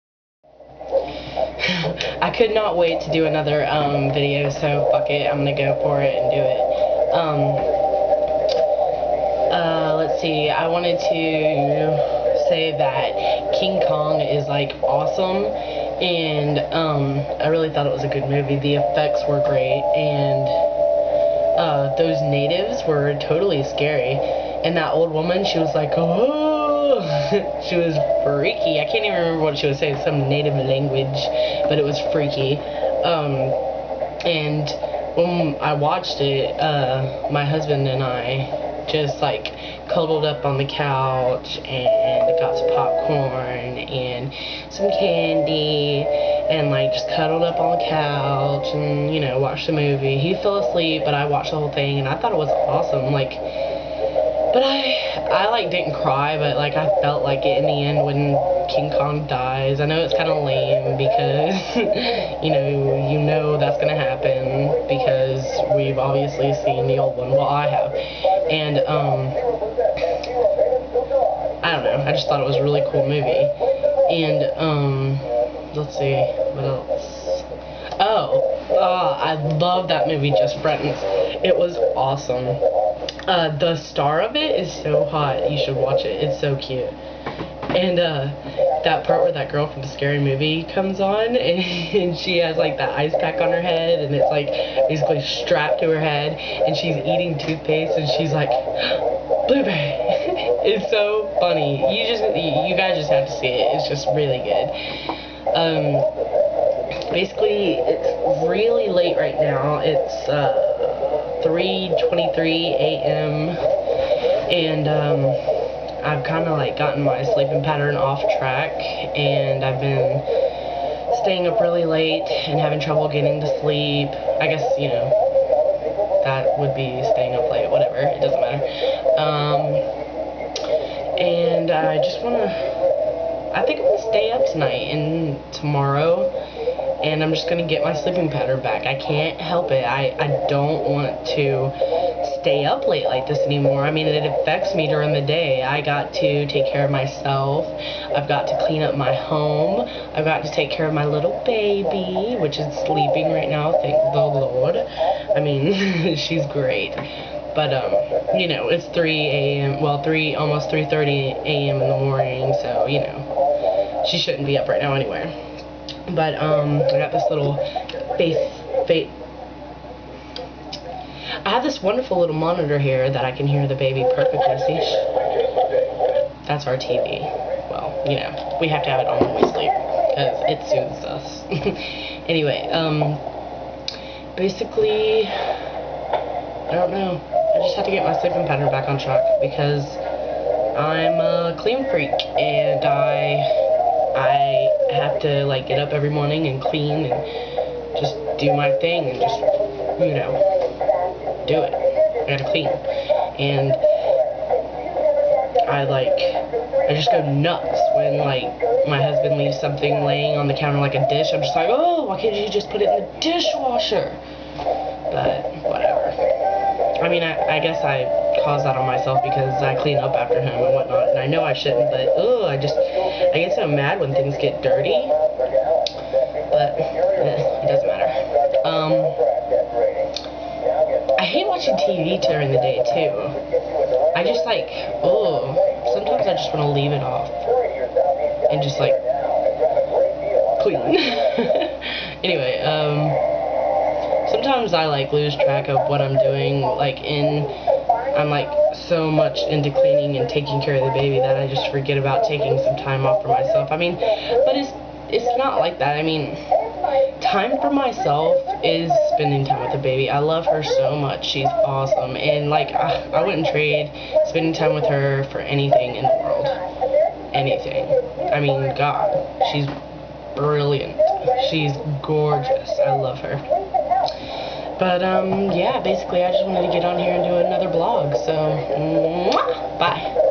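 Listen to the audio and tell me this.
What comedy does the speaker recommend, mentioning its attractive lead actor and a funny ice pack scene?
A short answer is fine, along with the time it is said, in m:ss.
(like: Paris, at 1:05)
Just Friends, at 1:20.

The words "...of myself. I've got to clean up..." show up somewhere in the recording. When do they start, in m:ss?
2:26.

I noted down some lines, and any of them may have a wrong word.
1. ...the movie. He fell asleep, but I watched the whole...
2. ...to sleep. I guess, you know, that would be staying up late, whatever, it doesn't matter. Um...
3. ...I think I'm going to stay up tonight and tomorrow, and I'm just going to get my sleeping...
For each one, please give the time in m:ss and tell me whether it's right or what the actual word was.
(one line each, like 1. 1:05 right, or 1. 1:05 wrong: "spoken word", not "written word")
1. 0:49 right
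2. 2:03 right
3. 2:13 right.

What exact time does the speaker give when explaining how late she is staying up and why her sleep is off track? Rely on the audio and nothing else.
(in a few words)
3:23 a.m.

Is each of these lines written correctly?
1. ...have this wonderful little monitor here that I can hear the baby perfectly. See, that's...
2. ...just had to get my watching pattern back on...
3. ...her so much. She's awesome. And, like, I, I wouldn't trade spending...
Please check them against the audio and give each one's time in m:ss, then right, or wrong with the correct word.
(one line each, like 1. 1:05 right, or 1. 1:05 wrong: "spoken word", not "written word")
1. 2:51 right
2. 3:07 wrong: "sleeping", not "watching"
3. 4:20 right.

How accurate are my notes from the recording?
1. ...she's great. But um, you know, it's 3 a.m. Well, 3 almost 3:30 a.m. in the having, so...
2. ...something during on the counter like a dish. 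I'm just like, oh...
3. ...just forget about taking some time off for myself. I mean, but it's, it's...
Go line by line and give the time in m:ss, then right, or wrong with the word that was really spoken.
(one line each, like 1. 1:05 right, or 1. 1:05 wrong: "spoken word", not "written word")
1. 2:36 wrong: "morning", not "having"
2. 3:29 wrong: "laying", not "during"
3. 4:11 right.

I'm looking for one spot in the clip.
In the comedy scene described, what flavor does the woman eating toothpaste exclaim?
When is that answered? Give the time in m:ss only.
1:39.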